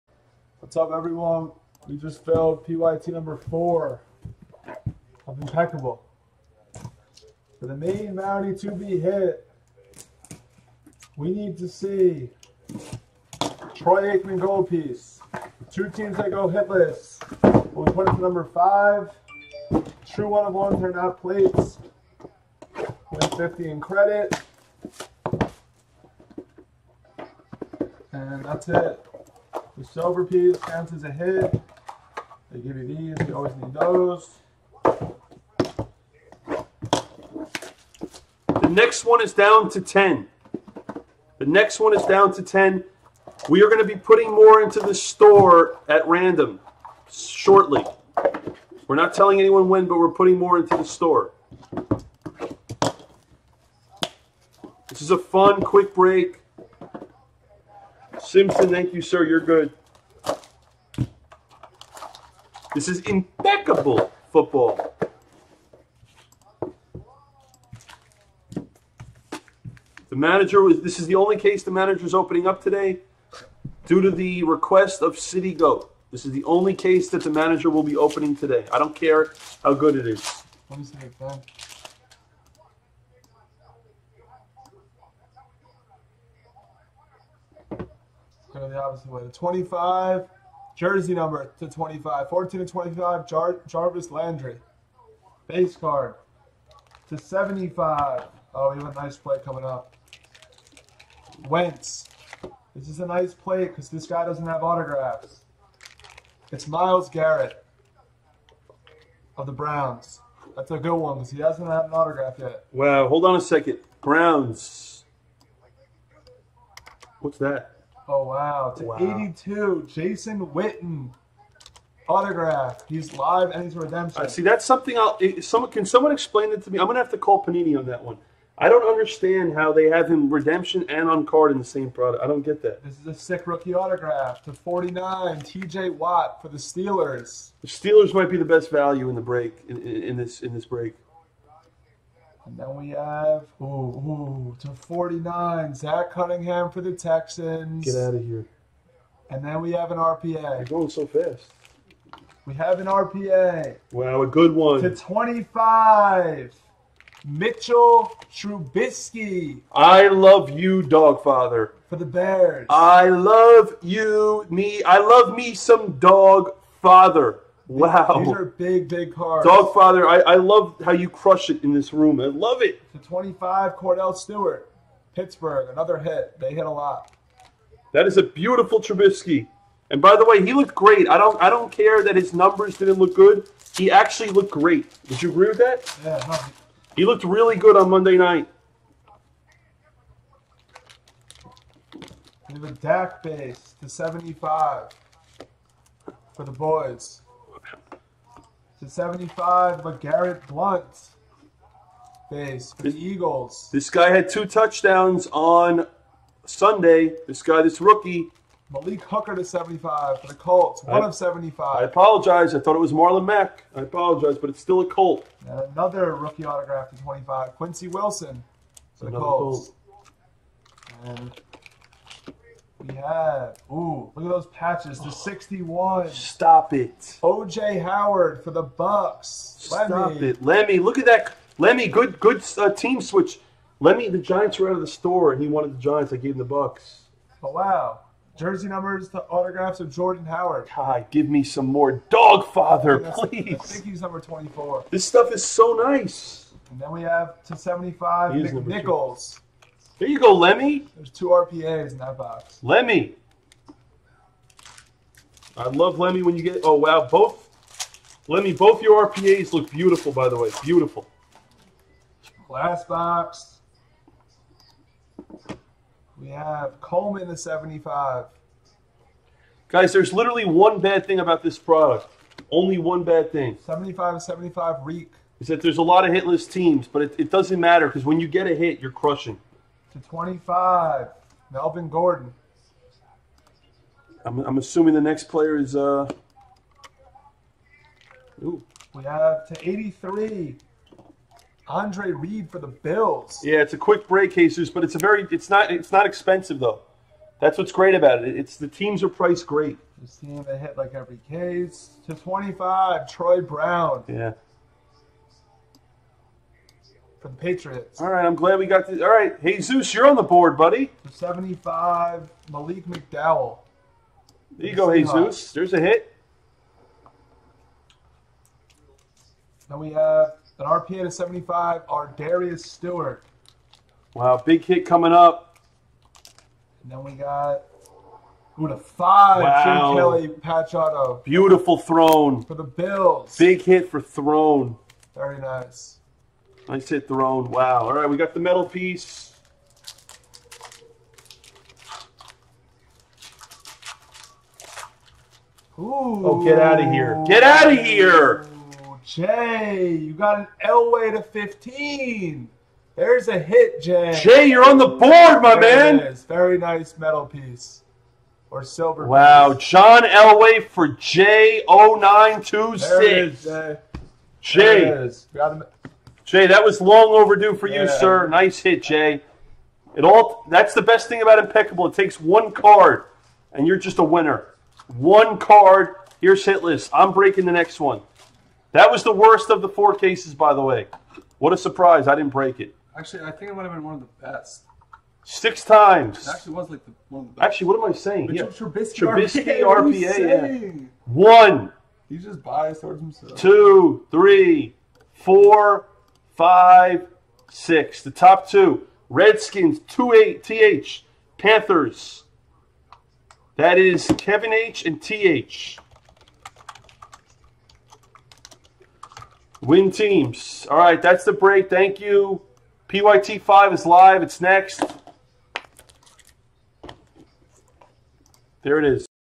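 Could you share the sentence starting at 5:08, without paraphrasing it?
All right, Hey Zeus, you're on the board, buddy.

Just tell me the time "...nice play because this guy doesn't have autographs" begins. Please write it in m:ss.
1:43.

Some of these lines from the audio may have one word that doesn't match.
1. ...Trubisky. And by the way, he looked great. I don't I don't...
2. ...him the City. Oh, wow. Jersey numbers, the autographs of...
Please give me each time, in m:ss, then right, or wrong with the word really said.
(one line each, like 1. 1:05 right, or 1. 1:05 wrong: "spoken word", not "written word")
1. 2:58 right
2. 3:56 wrong: "Bucks", not "City".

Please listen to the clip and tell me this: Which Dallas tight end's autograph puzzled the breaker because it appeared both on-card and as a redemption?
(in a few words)
Jason Witten.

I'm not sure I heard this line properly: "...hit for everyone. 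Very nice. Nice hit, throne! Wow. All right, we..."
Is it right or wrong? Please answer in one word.
wrong.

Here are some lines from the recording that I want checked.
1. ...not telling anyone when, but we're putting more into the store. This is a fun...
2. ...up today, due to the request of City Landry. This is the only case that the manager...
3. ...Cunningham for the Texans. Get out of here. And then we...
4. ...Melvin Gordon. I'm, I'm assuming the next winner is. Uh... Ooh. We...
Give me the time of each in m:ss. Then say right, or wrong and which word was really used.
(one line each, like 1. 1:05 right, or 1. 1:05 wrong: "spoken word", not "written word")
1. 0:48 right
2. 1:12 wrong: "Goat", not "Landry"
3. 2:26 right
4. 4:41 wrong: "player", not "winner".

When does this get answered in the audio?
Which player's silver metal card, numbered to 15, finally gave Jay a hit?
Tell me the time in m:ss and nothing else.
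5:59.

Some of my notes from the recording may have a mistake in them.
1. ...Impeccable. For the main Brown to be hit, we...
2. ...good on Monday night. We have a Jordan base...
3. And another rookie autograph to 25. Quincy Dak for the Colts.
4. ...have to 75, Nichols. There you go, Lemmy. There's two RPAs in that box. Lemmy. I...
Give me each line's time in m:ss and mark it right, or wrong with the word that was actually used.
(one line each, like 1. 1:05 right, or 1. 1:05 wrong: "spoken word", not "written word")
1. 0:05 wrong: "Mountie", not "Brown"
2. 3:07 wrong: "Dak", not "Jordan"
3. 3:35 wrong: "Wilson", not "Dak"
4. 4:07 right.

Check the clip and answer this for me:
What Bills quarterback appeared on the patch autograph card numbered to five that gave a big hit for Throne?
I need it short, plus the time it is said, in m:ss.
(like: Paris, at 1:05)
Jim Kelly, at 5:29.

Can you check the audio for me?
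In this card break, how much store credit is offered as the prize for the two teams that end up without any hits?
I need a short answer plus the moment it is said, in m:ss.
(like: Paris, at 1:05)
50, at 0:23.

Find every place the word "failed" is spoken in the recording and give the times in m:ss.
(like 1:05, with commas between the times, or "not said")
0:02.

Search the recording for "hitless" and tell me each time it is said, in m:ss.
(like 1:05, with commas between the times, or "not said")
0:16, 4:36, 6:16.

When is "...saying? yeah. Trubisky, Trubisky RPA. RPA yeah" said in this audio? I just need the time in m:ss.
6:27.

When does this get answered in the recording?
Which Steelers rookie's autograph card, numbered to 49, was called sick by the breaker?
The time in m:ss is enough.
2:15.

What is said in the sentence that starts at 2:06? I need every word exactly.
I'm going to have to call Panini on that one.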